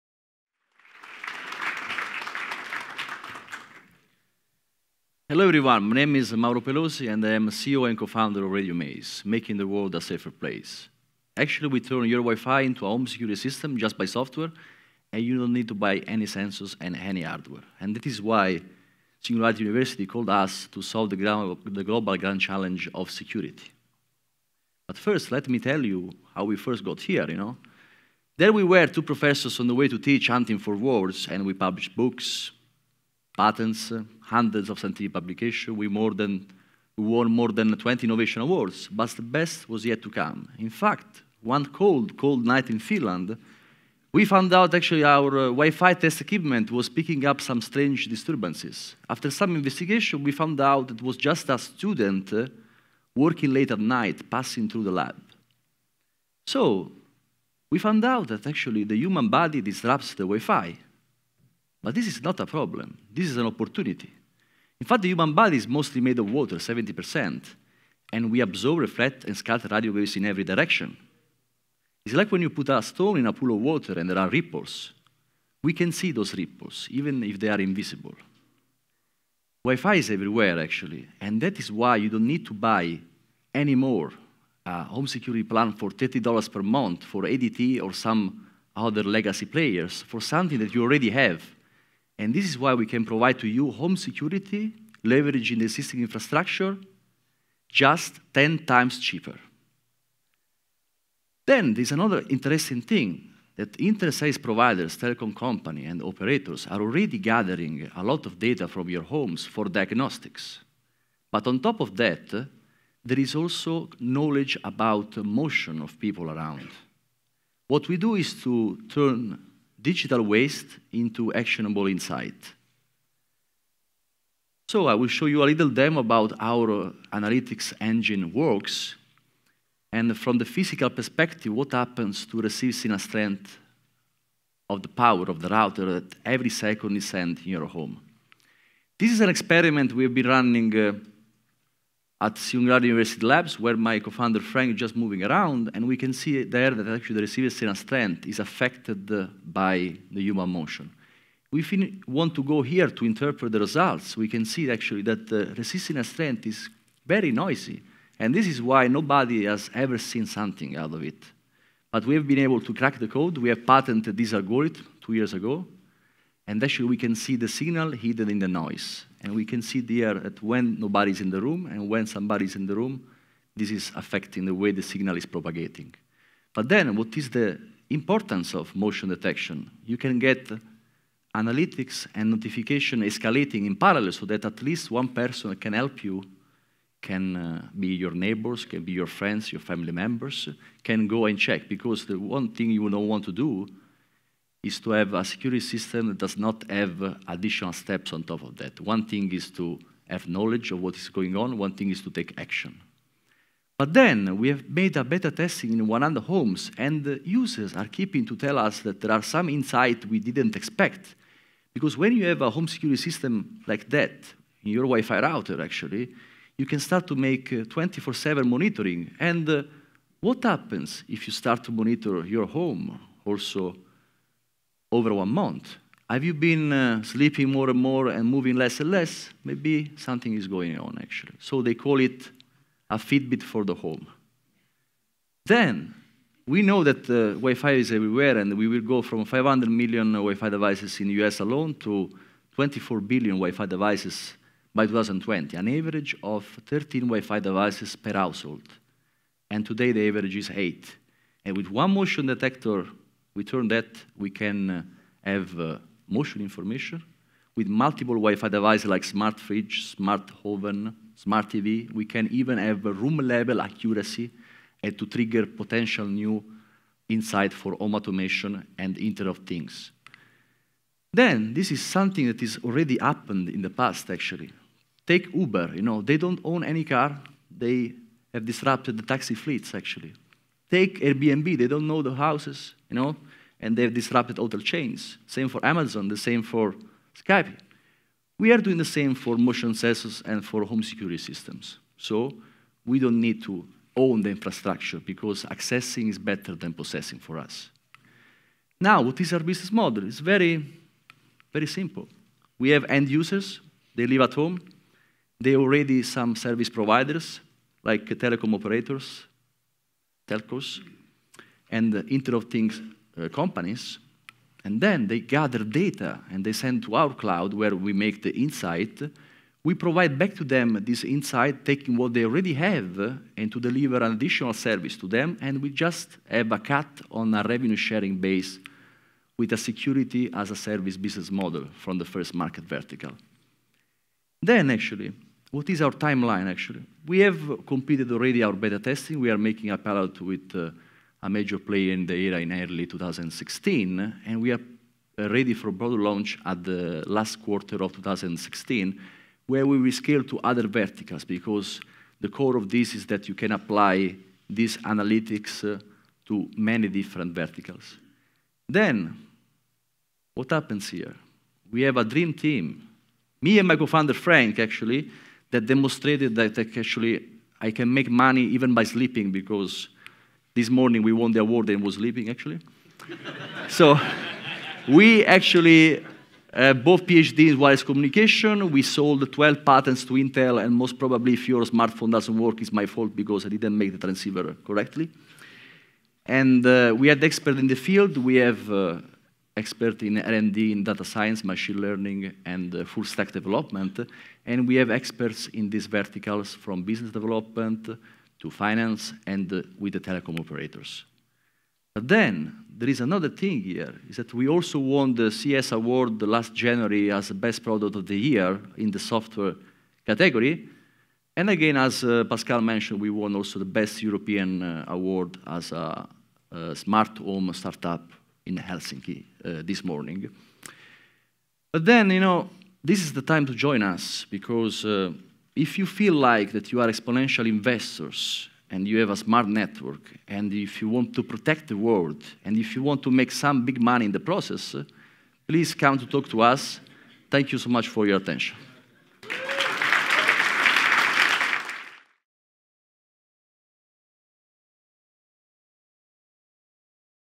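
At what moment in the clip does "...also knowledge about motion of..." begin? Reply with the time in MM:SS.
01:53.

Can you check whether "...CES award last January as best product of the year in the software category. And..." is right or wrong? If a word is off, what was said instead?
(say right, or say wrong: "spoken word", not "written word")
right.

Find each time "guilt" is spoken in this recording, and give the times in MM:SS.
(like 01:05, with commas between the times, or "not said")
not said.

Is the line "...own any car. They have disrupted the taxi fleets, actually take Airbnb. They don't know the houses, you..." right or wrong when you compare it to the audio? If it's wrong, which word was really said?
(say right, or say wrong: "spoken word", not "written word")
right.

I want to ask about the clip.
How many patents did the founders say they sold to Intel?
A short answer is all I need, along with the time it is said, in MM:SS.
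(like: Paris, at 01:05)
12, at 06:19.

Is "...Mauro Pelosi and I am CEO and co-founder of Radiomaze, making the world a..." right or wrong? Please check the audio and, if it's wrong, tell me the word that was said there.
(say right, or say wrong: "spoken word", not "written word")
right.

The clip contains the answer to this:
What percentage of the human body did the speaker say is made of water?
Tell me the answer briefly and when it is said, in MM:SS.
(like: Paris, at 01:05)
70%, at 01:06.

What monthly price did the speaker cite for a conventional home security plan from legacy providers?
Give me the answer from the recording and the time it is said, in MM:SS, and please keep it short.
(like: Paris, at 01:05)
$30, at 01:25.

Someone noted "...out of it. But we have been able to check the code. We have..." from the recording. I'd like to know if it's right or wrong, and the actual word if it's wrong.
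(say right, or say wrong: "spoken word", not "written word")
wrong: "crack", not "check".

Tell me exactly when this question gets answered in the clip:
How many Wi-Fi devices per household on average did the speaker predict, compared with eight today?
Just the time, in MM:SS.
04:06.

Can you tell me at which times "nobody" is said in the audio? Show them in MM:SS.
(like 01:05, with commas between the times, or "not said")
02:38, 02:50.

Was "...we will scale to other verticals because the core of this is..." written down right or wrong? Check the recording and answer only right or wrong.
right.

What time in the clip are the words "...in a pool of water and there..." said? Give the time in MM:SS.
01:13.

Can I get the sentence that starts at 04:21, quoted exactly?
We can even have room-level accuracy and to trigger potential new insight for home automation and Internet of Things.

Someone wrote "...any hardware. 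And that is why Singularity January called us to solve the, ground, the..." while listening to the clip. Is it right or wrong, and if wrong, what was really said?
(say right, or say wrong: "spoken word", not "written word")
wrong: "University", not "January".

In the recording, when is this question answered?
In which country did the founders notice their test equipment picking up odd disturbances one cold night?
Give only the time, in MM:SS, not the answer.
00:42.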